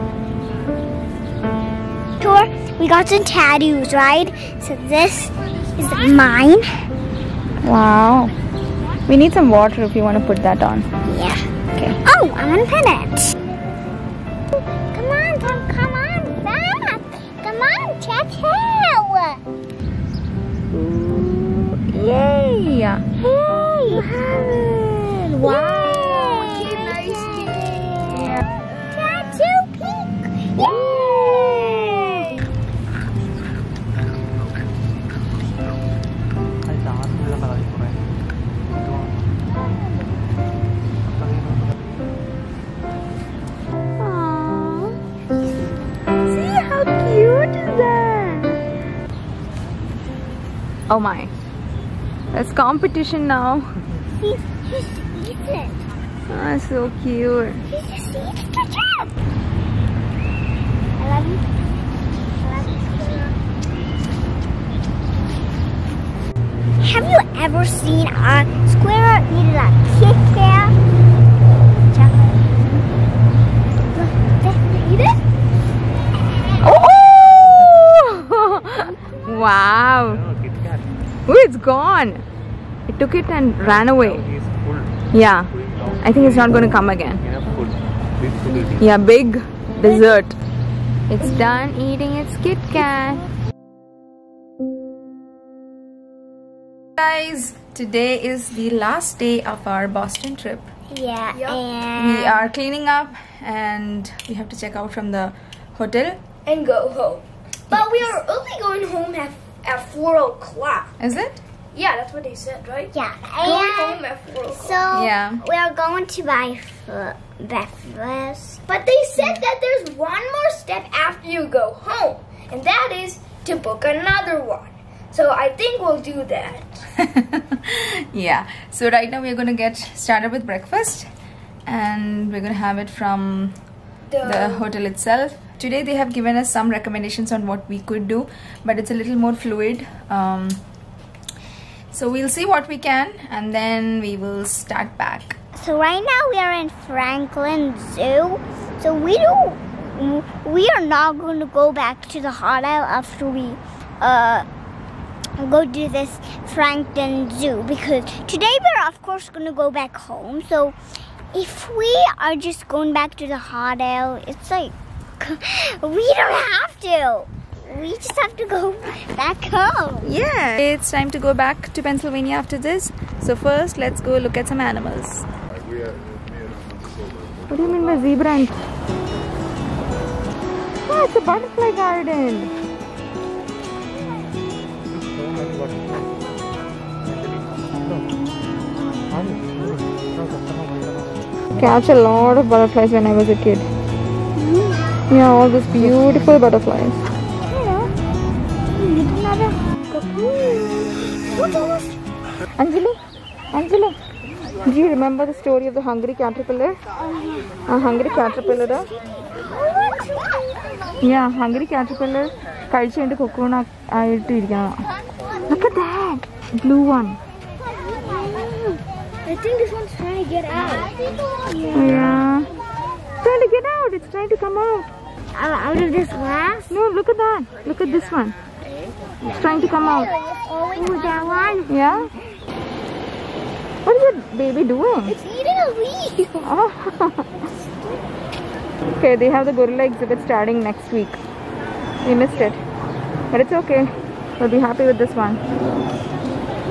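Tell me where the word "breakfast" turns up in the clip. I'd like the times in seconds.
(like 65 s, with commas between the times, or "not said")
117 s, 130 s.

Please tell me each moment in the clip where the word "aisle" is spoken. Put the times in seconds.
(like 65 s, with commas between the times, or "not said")
152 s, 163 s.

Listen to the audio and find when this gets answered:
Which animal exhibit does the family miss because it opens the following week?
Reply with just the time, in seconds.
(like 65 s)
239 s.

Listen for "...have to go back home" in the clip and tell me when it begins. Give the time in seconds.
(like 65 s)
168 s.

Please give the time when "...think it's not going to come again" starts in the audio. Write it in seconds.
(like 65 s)
86 s.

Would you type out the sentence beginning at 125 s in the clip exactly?
So I think we'll do that.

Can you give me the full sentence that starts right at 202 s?
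Anjali, Anjali, do you remember the story of the hungry caterpillar?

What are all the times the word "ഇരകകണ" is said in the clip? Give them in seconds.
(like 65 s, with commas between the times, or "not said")
214 s.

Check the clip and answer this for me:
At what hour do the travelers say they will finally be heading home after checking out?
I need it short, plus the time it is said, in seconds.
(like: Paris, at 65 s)
4 o'clock, at 109 s.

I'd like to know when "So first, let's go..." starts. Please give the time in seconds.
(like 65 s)
173 s.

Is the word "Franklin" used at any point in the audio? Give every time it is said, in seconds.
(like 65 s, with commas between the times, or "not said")
146 s, 156 s.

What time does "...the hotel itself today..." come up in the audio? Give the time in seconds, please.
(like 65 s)
134 s.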